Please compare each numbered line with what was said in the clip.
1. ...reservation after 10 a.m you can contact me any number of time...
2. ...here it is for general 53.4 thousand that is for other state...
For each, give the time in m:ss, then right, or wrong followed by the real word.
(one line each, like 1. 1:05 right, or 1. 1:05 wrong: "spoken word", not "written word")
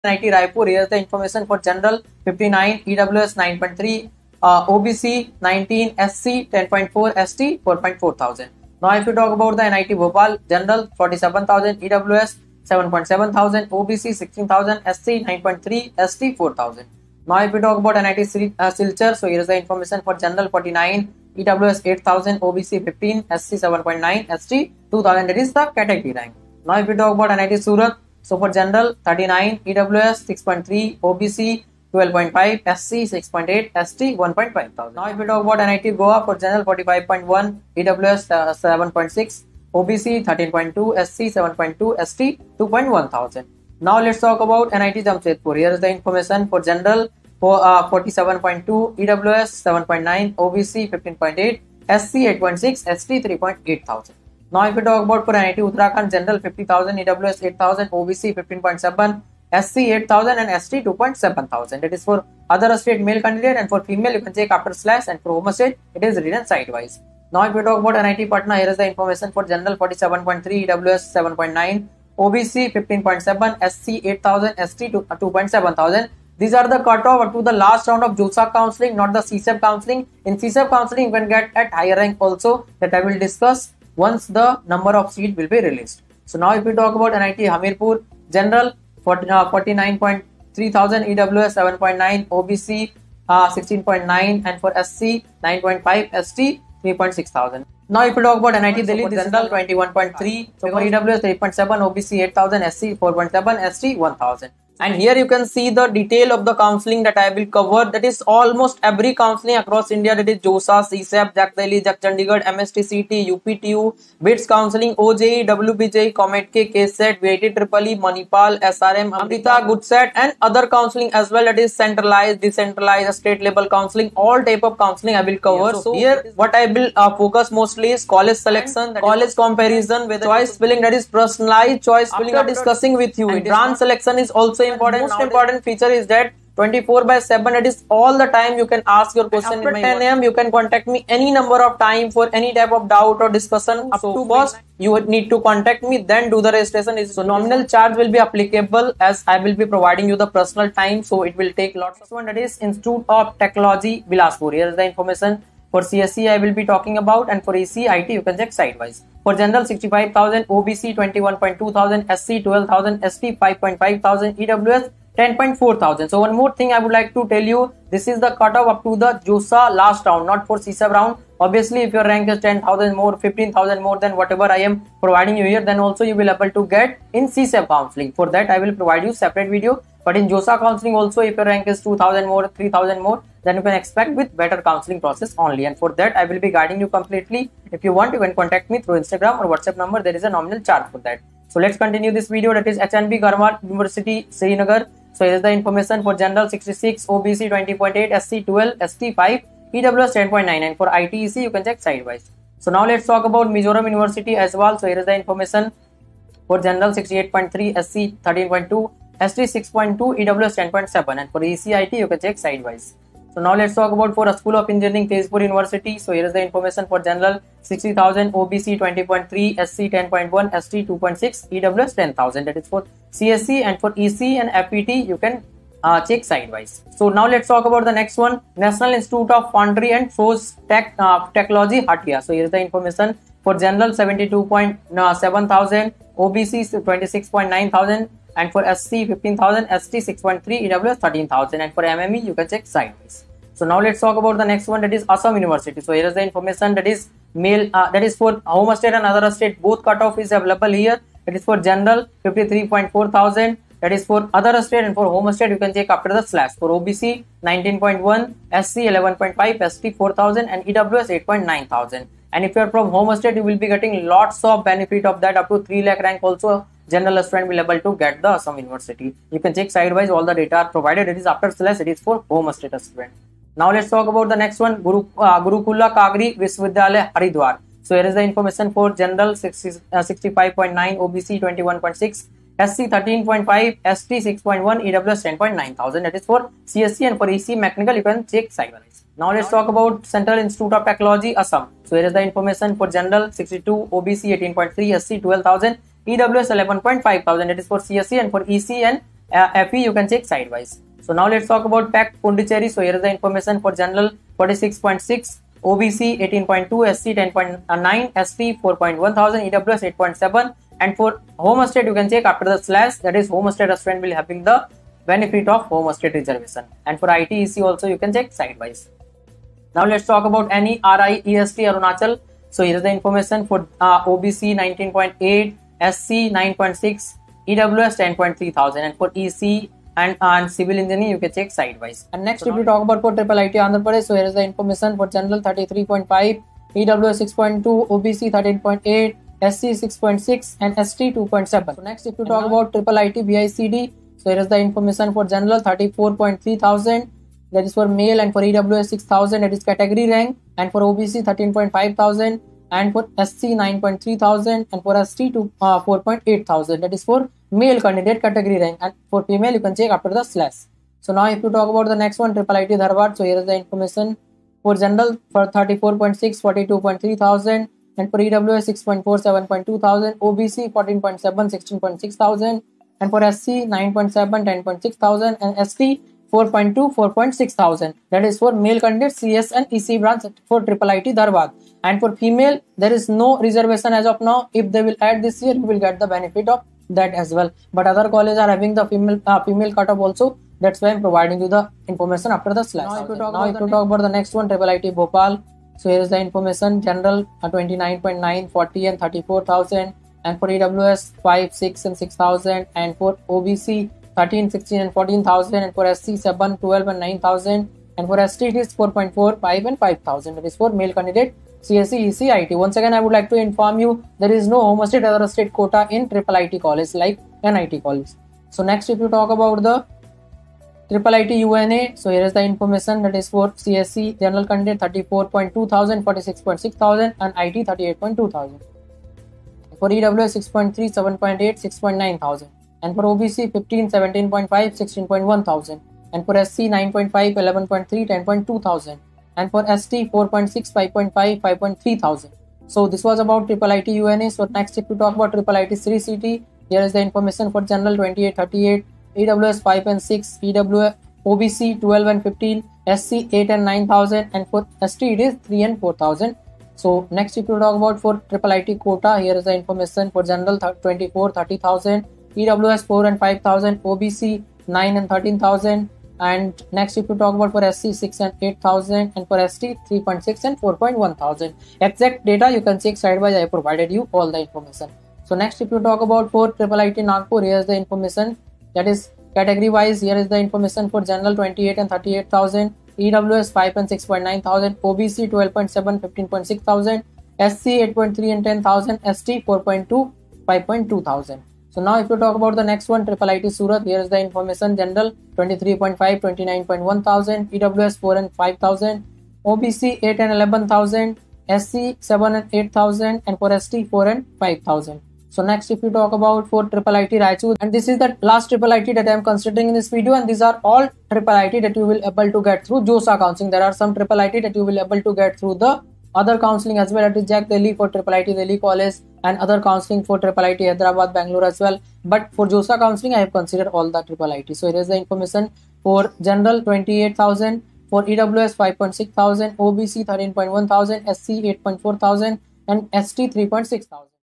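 1. 2:19 wrong: "question", not "reservation"
2. 4:10 right.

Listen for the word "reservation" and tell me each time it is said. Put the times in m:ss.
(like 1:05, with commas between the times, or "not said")
5:16, 6:23.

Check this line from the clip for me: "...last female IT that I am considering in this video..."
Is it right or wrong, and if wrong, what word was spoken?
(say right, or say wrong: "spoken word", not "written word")
wrong: "triple", not "female".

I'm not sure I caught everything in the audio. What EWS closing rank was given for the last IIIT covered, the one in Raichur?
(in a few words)
5.6 thousand.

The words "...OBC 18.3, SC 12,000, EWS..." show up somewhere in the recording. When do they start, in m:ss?
4:53.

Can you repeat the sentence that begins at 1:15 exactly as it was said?
Uh, These are the cutoff to the last round of JOSA counseling, not the CSAB counseling.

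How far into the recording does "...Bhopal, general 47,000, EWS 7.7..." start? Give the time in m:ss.
0:09.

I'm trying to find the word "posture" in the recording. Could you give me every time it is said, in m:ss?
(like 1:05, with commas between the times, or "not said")
not said.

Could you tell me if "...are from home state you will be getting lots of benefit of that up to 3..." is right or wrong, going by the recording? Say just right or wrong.
right.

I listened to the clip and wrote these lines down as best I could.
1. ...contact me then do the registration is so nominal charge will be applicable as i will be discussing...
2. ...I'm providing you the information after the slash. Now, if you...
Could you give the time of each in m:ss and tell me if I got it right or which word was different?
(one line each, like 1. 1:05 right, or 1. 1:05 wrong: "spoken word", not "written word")
1. 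2:25 wrong: "providing", not "discussing"
2. 6:30 right.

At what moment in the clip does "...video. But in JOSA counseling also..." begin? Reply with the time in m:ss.
2:59.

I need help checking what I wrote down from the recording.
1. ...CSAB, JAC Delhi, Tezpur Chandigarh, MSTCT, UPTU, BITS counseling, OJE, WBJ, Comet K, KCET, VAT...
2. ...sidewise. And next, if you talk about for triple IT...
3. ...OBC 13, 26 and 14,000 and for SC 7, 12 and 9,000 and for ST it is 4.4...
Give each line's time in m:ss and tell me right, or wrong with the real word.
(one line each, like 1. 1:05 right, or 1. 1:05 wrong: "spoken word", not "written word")
1. 1:50 wrong: "JAC", not "Tezpur"
2. 5:31 right
3. 6:43 wrong: "16", not "26".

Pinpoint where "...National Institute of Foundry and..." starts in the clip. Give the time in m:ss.
3:48.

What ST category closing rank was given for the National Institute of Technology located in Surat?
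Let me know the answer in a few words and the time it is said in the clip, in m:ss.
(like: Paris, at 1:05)
1.5 thousand, at 0:33.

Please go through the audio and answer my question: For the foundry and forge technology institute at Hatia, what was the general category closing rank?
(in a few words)
72.7 thousand.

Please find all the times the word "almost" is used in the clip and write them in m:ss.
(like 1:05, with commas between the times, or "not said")
1:48.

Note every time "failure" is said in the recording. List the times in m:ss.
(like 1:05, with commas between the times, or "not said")
not said.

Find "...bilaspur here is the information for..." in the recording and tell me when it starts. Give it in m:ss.
2:34.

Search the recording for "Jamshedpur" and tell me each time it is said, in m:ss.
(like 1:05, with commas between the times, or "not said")
0:45.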